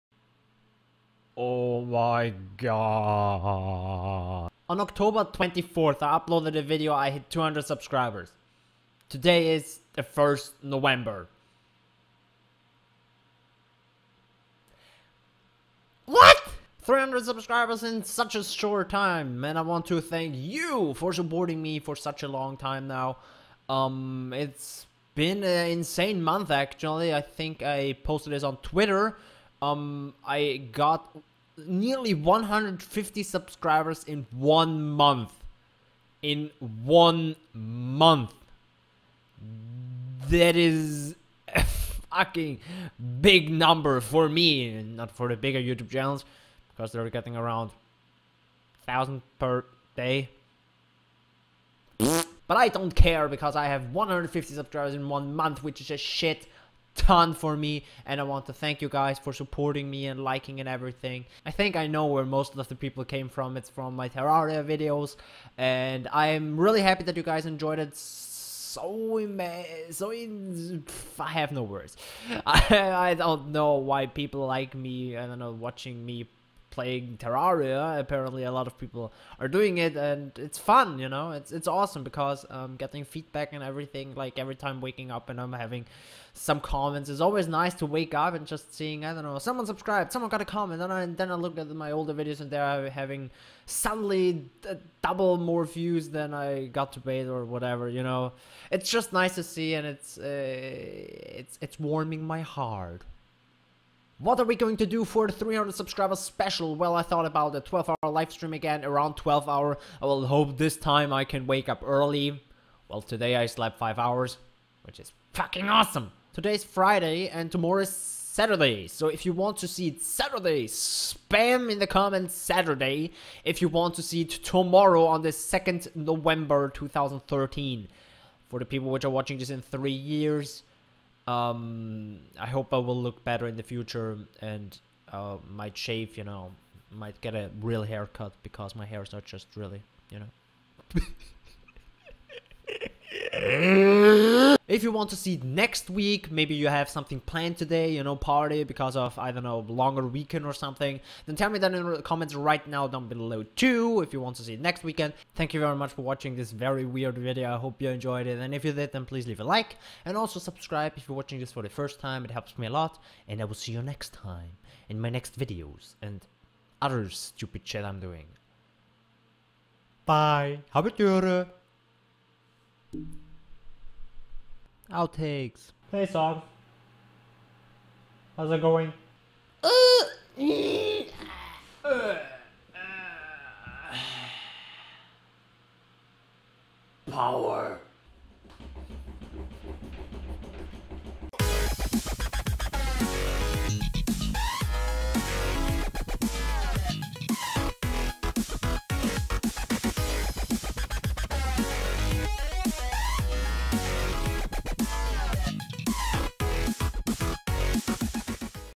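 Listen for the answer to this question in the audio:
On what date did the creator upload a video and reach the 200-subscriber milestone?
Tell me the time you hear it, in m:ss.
0:04.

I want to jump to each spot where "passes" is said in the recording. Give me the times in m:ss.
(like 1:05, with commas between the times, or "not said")
not said.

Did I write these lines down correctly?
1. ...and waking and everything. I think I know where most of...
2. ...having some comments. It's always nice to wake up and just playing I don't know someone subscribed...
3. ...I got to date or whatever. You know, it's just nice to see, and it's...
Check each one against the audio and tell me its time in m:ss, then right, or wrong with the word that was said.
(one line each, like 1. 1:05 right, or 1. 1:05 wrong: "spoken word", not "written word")
1. 1:00 wrong: "liking", not "waking"
2. 1:25 wrong: "seeing", not "playing"
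3. 1:36 right.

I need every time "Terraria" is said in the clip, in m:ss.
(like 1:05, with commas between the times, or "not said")
1:04, 1:17.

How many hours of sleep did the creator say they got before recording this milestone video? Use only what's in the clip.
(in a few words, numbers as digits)
5 hours.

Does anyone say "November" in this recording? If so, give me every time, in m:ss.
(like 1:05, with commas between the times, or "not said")
0:10, 2:05.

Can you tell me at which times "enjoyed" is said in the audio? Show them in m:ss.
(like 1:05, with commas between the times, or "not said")
1:07, 2:37.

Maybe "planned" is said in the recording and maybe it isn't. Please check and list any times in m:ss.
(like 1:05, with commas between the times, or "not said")
2:27.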